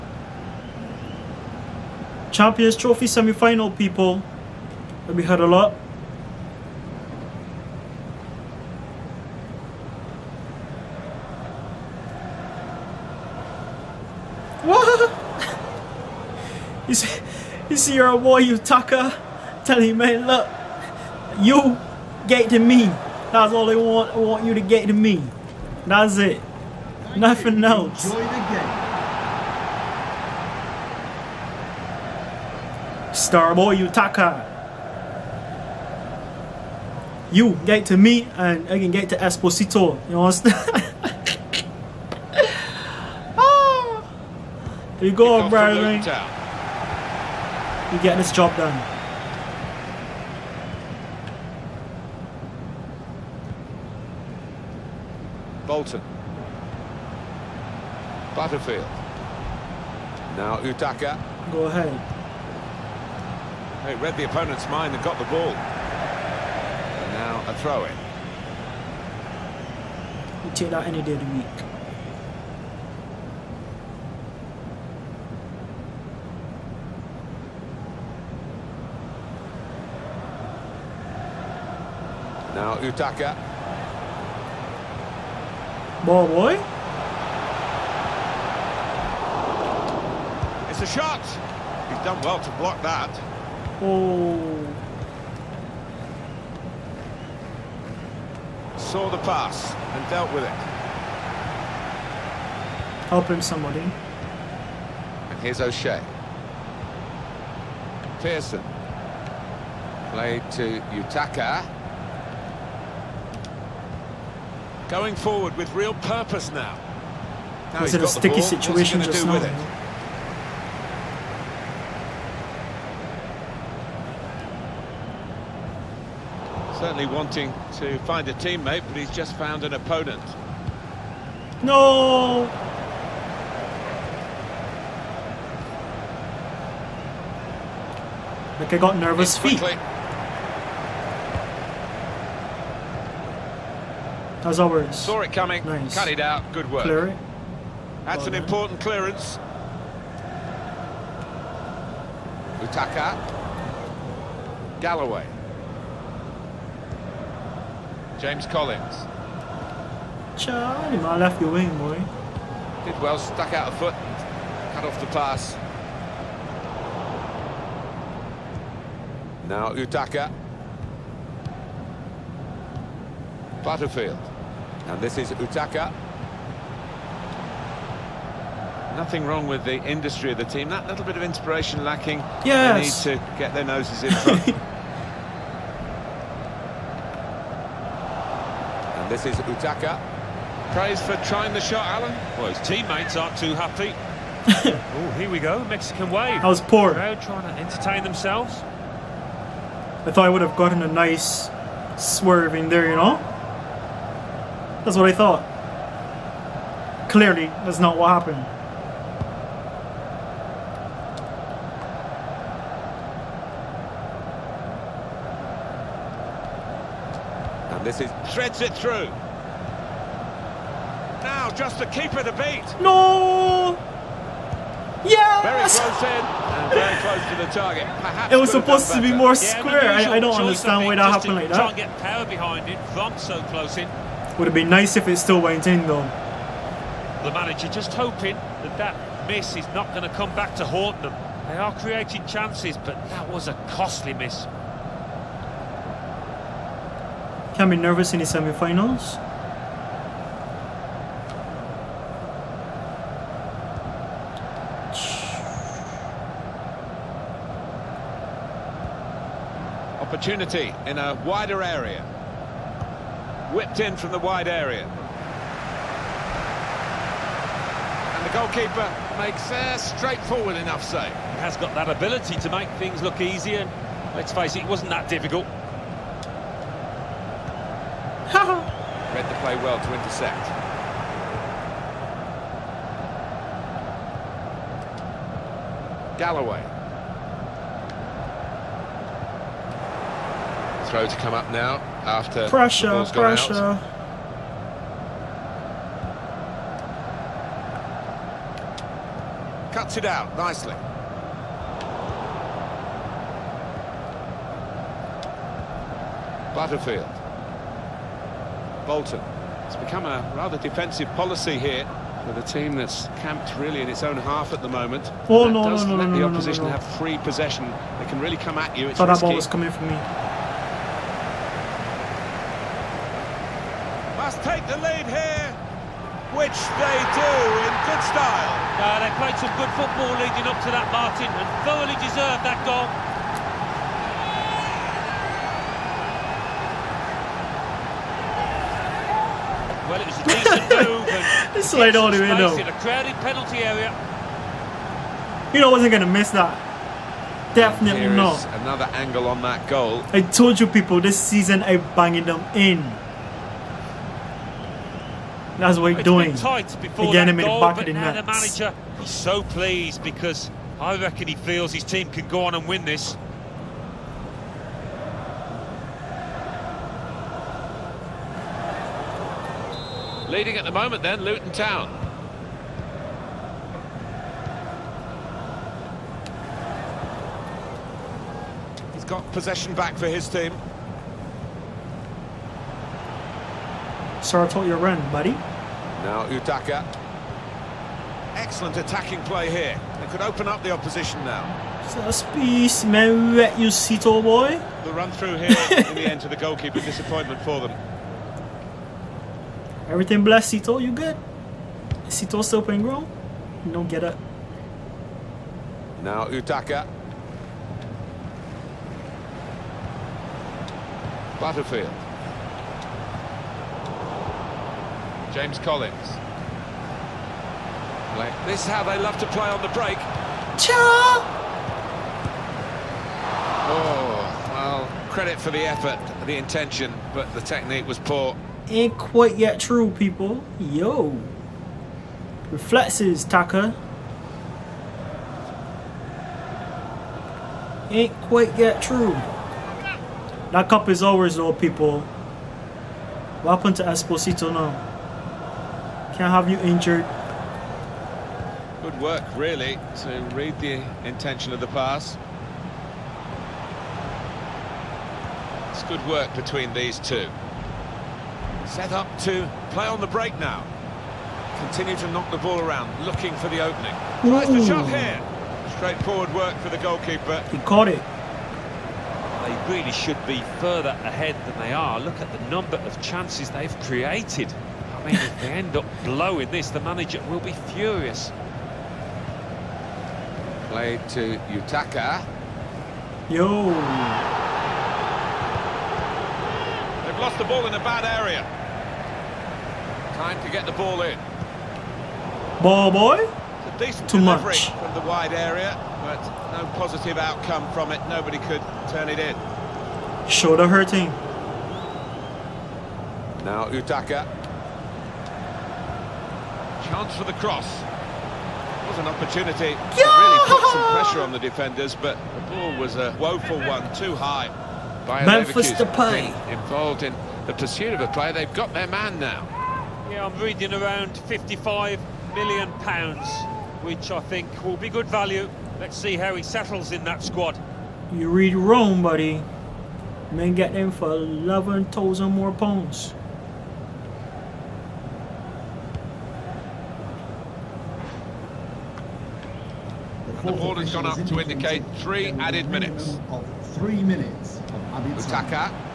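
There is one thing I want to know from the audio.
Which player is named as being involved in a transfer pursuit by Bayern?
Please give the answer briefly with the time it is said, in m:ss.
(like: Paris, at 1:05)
Memphis Depay, at 8:35.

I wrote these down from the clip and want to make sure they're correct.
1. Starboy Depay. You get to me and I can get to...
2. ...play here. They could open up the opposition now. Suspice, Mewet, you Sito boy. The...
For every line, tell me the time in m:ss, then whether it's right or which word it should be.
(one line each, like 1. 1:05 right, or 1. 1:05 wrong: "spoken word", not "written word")
1. 0:33 wrong: "Utaka", not "Depay"
2. 6:29 right.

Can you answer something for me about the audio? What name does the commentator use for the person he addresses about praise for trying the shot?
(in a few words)
Alan.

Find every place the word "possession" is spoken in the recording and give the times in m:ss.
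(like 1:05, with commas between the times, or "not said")
5:17, 6:19.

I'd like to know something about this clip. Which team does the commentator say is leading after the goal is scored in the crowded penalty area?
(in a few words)
Luton Town.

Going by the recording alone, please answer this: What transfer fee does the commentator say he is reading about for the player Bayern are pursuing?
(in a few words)
55 million pounds.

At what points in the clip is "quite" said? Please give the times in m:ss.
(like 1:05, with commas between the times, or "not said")
7:08, 7:18.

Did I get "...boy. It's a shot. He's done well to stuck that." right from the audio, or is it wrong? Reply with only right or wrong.
wrong.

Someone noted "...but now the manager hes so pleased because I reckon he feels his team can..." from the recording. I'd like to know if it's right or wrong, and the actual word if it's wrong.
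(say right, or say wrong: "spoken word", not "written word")
right.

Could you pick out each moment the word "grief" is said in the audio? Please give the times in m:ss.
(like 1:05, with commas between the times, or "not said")
not said.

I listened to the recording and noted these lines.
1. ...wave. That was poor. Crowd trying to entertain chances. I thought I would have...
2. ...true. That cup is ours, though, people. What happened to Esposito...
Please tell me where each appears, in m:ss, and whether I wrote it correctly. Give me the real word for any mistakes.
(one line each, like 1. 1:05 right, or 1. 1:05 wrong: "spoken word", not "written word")
1. 3:16 wrong: "themselves", not "chances"
2. 7:18 right.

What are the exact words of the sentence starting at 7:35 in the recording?
It's good work between these two.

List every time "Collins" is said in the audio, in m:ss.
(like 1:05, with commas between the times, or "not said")
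2:38, 6:55.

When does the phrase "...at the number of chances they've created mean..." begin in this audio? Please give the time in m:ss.
7:52.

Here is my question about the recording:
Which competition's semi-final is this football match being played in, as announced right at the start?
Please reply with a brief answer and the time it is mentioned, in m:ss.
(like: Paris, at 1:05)
Champions Trophy, at 0:02.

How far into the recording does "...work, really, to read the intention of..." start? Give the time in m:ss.
7:29.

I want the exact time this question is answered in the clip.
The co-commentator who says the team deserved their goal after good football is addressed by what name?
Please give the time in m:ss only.
5:30.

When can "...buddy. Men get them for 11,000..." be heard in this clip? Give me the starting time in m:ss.
8:49.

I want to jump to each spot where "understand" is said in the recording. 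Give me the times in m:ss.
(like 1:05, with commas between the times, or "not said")
0:40, 3:50.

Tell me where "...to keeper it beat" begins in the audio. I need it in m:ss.
3:41.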